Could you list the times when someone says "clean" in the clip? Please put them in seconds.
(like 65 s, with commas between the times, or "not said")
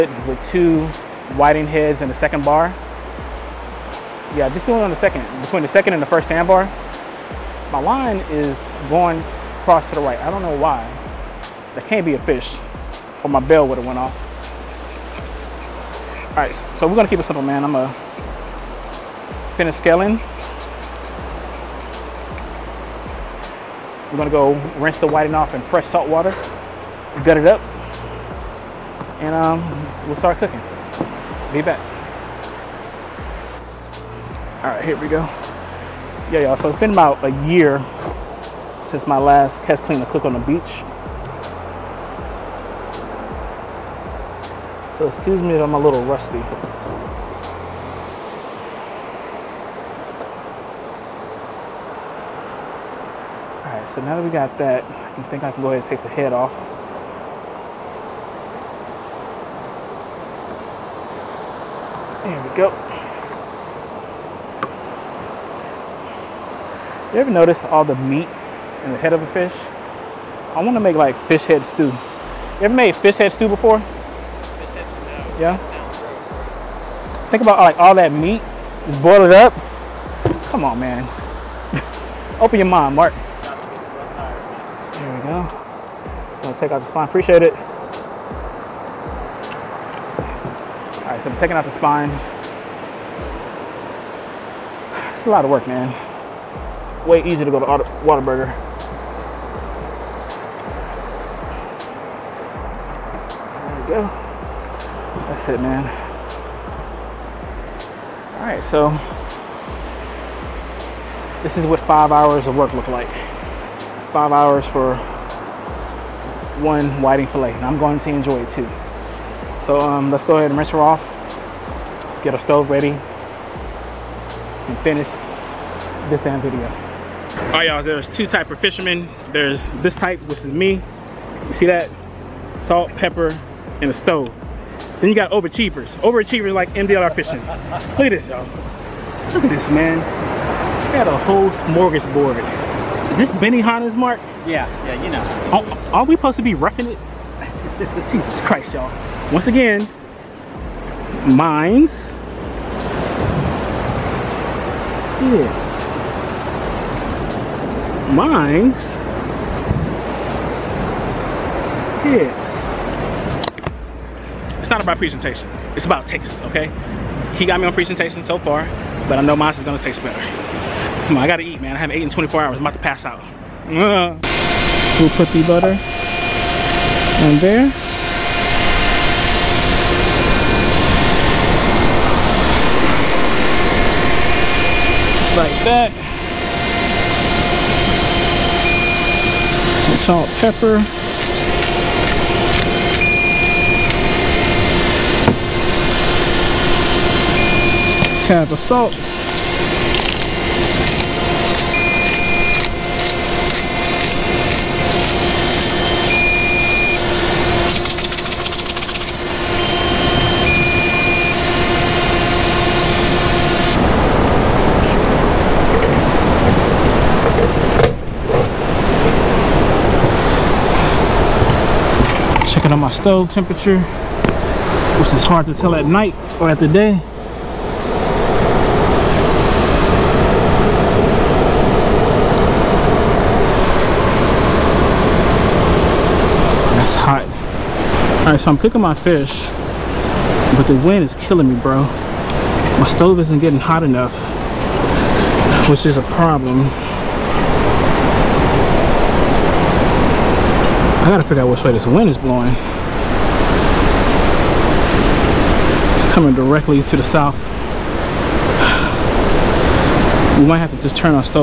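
39 s.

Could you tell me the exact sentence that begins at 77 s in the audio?
Think about like all that meat, is boiled up.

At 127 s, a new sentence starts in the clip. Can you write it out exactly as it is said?
All right, y'all, there's two type of fishermen.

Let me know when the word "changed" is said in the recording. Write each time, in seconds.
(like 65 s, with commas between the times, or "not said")
not said.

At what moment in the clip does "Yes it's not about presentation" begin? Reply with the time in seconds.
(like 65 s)
162 s.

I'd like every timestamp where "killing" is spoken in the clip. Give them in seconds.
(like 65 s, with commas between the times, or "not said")
241 s.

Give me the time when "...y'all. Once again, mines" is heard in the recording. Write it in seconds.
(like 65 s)
148 s.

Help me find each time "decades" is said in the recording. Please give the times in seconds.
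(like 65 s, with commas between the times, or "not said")
not said.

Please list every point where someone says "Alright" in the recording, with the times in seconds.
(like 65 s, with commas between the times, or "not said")
53 s, 238 s.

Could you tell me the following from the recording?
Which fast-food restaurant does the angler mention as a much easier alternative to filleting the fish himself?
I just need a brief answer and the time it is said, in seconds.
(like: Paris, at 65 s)
Whataburger, at 98 s.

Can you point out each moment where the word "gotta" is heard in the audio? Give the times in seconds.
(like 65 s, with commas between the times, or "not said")
171 s, 251 s.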